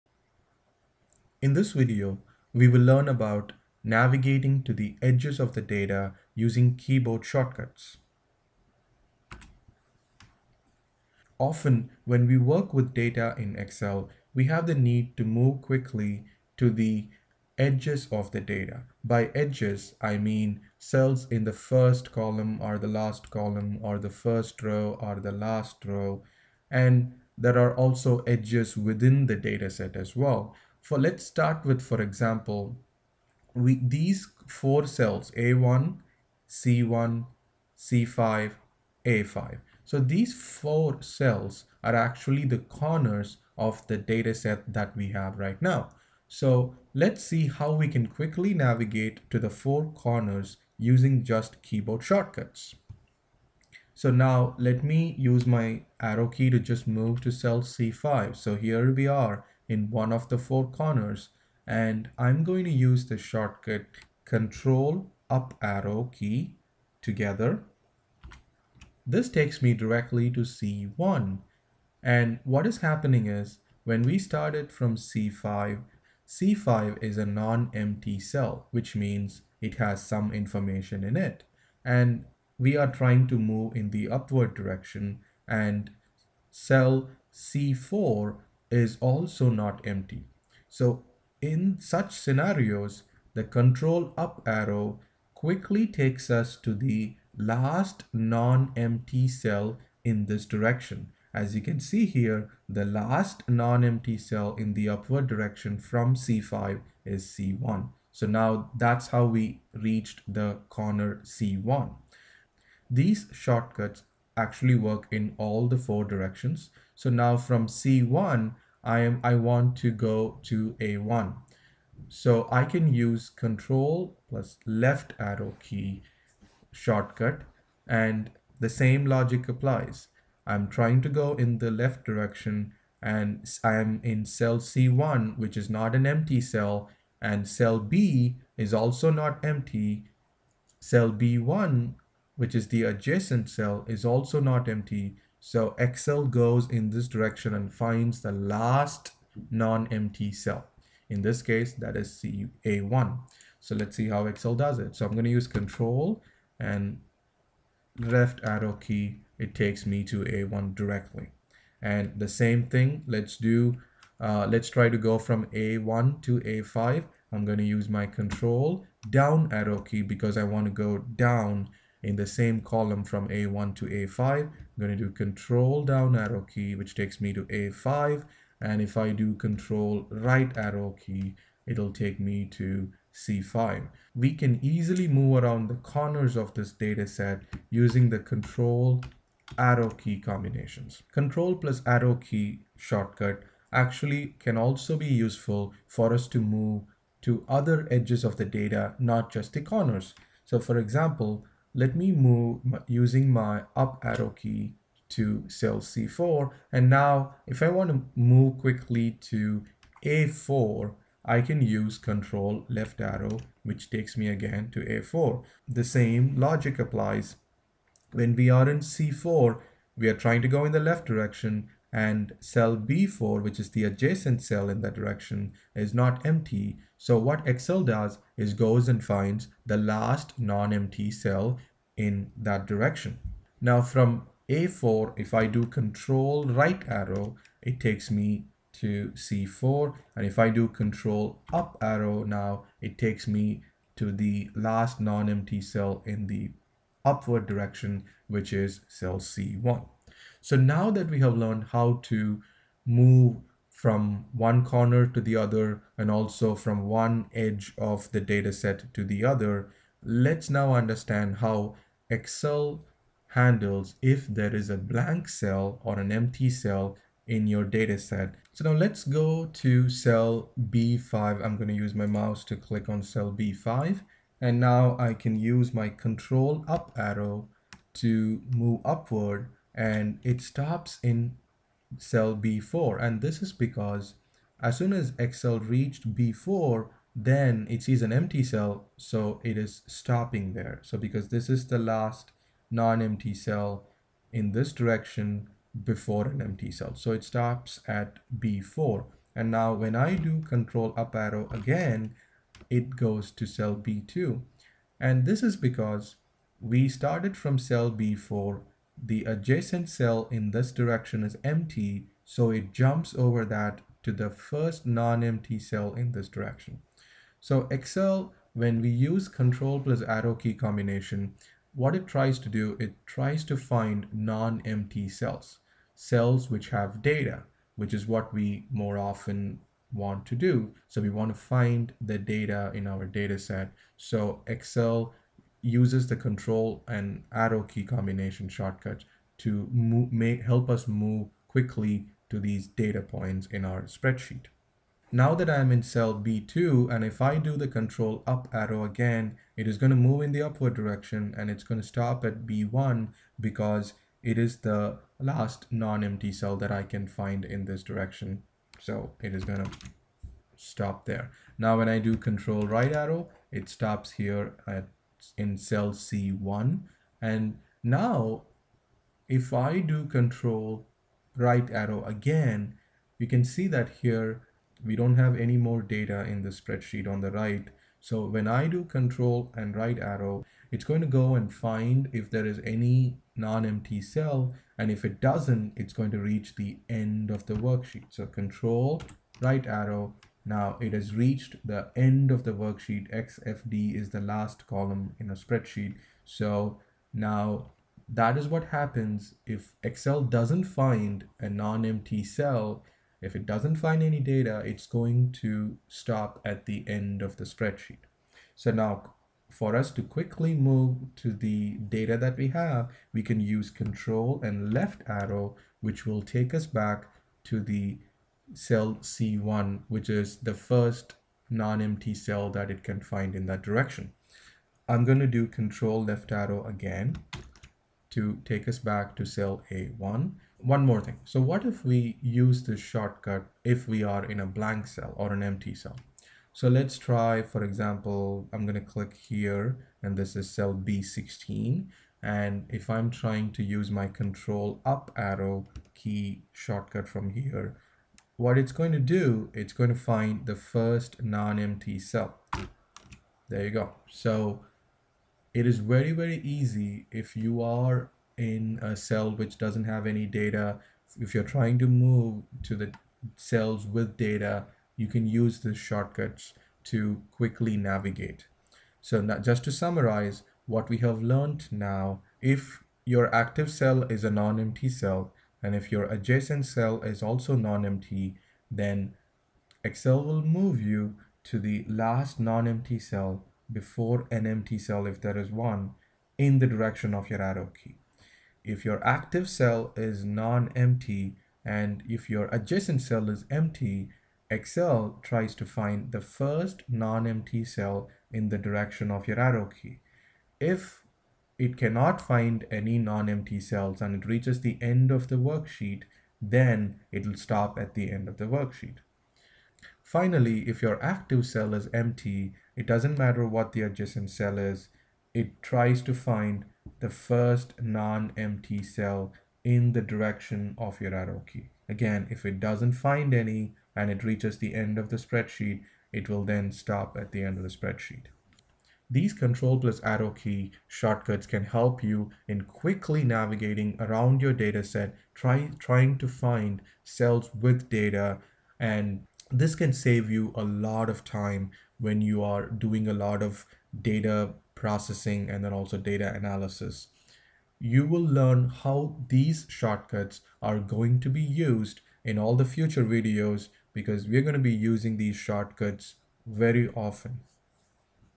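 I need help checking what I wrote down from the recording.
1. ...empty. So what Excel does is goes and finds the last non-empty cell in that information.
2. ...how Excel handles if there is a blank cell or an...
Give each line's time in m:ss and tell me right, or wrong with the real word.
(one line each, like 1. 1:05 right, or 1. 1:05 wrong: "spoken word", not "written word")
1. 3:46 wrong: "direction", not "information"
2. 4:21 right.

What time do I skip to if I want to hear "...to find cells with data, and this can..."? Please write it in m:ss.
8:56.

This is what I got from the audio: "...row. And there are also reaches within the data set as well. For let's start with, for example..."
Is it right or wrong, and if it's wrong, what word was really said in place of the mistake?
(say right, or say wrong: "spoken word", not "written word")
wrong: "edges", not "reaches".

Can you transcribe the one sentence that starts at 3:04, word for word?
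We can easily move around the corners of this data set using the control arrow key combinations.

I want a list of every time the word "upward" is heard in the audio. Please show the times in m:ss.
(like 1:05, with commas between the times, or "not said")
1:24, 1:44, 4:07, 4:38, 5:50.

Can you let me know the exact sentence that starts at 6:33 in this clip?
XFD is the last column in a spreadsheet.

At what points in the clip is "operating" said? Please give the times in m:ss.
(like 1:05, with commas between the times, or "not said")
not said.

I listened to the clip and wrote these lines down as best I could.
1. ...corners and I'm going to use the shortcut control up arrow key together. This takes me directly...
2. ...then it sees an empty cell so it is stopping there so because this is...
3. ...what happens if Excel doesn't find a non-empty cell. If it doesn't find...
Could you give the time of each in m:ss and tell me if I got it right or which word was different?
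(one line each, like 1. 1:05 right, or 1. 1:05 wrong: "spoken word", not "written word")
1. 1:00 right
2. 4:47 right
3. 6:38 right.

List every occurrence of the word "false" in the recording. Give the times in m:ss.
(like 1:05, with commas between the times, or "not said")
not said.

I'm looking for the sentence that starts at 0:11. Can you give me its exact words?
Often, when we work with data in Excel, we have the need to move quickly to the edges of the data.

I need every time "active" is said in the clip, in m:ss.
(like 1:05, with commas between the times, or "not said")
7:53, 8:09, 8:31.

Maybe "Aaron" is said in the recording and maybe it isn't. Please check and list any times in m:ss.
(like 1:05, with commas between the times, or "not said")
not said.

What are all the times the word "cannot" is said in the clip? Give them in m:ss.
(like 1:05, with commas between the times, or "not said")
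8:21.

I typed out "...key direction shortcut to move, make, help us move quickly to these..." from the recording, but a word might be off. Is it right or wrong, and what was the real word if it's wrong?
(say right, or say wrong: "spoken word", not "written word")
wrong: "combination", not "direction".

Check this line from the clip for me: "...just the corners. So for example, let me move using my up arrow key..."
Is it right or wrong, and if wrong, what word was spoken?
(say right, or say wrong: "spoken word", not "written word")
right.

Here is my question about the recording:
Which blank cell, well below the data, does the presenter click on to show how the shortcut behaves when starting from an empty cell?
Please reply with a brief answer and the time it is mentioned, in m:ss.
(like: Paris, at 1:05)
B16, at 7:20.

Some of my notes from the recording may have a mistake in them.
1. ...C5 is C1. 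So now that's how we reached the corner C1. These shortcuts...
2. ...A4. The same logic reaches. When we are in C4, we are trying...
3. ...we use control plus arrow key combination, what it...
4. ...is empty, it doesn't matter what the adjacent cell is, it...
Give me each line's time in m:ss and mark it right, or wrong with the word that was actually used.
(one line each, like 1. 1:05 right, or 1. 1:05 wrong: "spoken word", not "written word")
1. 1:46 right
2. 3:34 wrong: "applies", not "reaches"
3. 5:18 right
4. 8:31 right.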